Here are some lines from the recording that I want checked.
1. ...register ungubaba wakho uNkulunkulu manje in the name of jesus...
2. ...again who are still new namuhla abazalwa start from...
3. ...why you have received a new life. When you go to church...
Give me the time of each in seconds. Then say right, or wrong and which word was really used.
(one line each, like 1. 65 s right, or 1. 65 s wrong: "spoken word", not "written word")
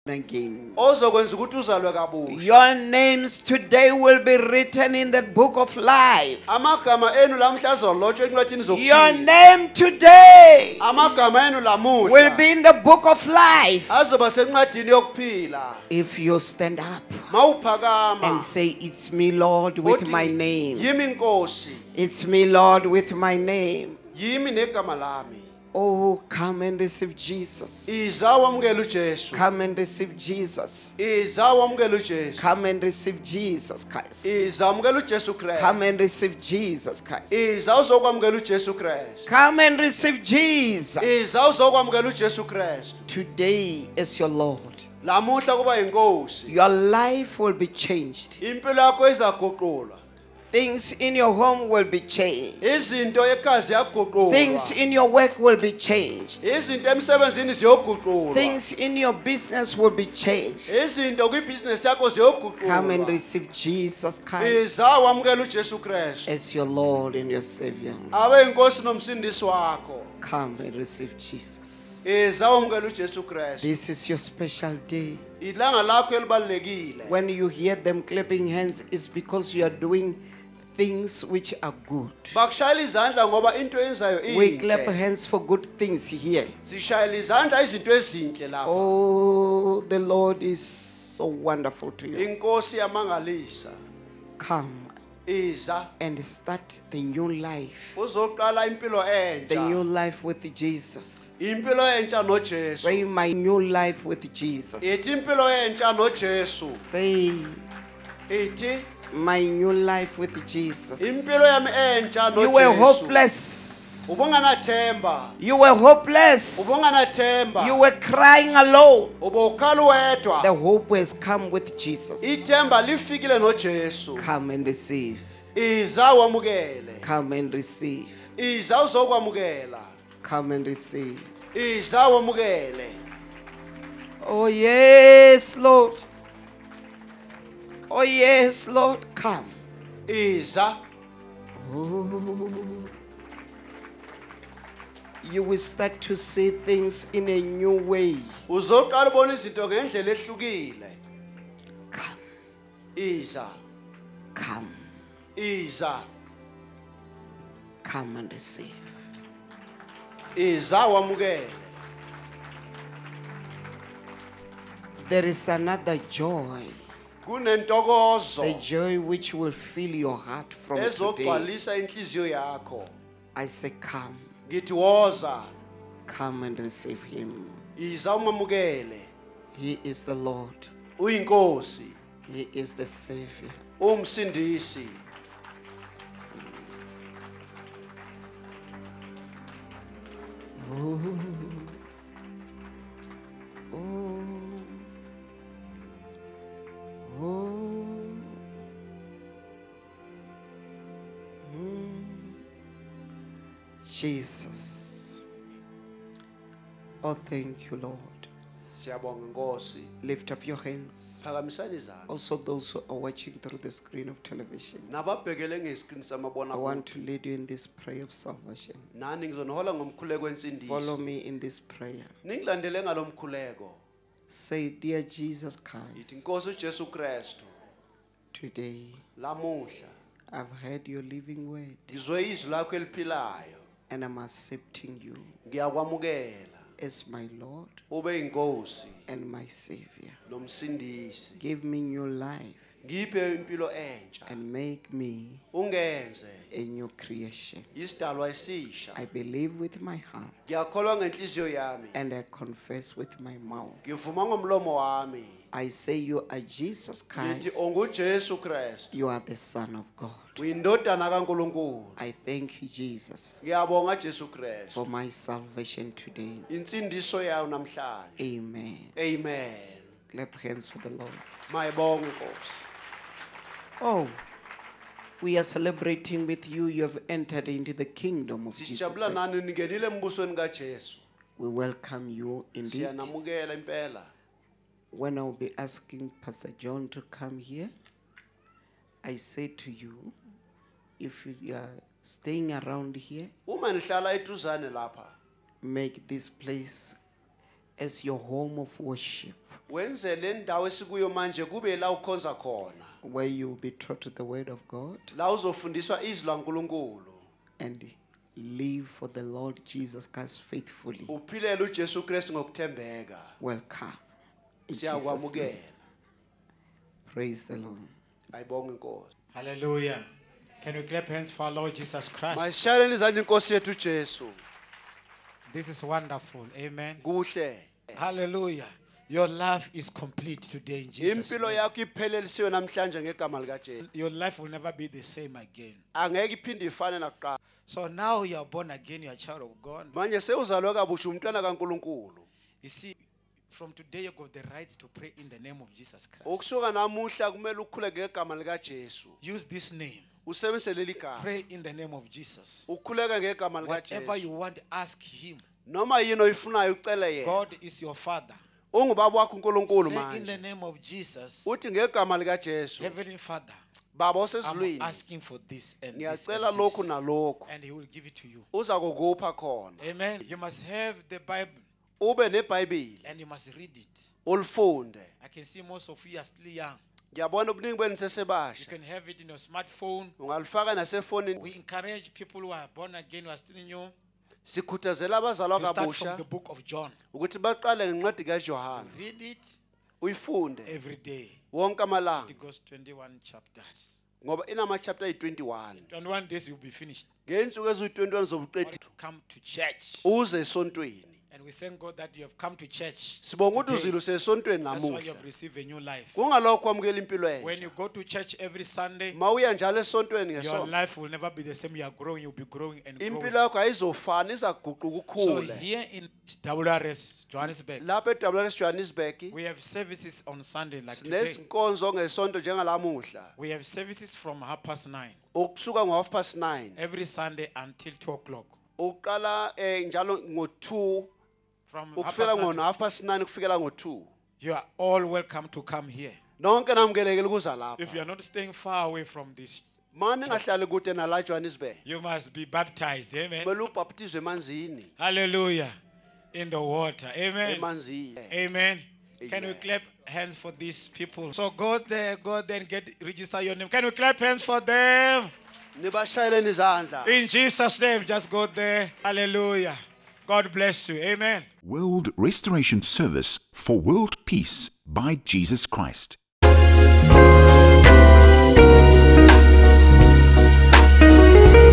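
1. 357 s wrong: "father", not "register"
2. 382 s wrong: "sikhuthazela", not "namuhla"
3. 404 s right.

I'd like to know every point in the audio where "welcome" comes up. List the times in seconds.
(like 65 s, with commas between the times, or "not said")
281 s, 313 s, 435 s.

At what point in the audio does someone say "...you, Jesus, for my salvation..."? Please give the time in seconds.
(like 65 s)
262 s.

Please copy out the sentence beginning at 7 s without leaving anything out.
Your name today will be in the book of life.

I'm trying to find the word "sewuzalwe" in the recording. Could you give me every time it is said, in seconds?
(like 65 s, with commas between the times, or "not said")
340 s.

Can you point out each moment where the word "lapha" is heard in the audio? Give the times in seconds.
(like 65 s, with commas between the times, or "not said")
88 s, 417 s, 437 s.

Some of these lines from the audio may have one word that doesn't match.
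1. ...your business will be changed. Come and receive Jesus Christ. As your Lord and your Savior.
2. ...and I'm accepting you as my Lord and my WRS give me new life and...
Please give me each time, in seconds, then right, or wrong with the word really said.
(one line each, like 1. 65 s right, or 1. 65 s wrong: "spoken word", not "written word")
1. 58 s right
2. 233 s wrong: "Savior", not "WRS".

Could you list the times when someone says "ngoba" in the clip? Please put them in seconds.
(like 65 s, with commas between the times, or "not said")
83 s, 394 s.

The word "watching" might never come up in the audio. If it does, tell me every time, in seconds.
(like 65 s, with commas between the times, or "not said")
212 s.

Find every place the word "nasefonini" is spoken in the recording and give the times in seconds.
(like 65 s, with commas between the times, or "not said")
380 s.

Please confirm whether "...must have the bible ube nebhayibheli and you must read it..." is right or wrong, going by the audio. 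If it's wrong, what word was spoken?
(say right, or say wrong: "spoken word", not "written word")
right.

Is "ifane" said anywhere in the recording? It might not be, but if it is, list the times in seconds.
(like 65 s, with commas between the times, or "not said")
336 s.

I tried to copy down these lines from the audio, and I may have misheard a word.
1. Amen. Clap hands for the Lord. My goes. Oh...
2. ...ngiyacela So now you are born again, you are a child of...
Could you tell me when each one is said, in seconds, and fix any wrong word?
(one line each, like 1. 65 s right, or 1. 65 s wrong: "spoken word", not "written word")
1. 268 s right
2. 336 s wrong: "nakuqala", not "ngiyacela".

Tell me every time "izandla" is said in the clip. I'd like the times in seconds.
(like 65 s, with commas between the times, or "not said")
82 s, 87 s.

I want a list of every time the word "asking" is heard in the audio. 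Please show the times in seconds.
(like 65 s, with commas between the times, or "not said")
285 s, 364 s.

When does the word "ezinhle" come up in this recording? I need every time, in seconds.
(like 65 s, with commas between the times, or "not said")
87 s.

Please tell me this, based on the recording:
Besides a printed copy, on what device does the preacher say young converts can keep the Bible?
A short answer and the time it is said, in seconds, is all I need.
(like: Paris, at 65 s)
smartphone, at 379 s.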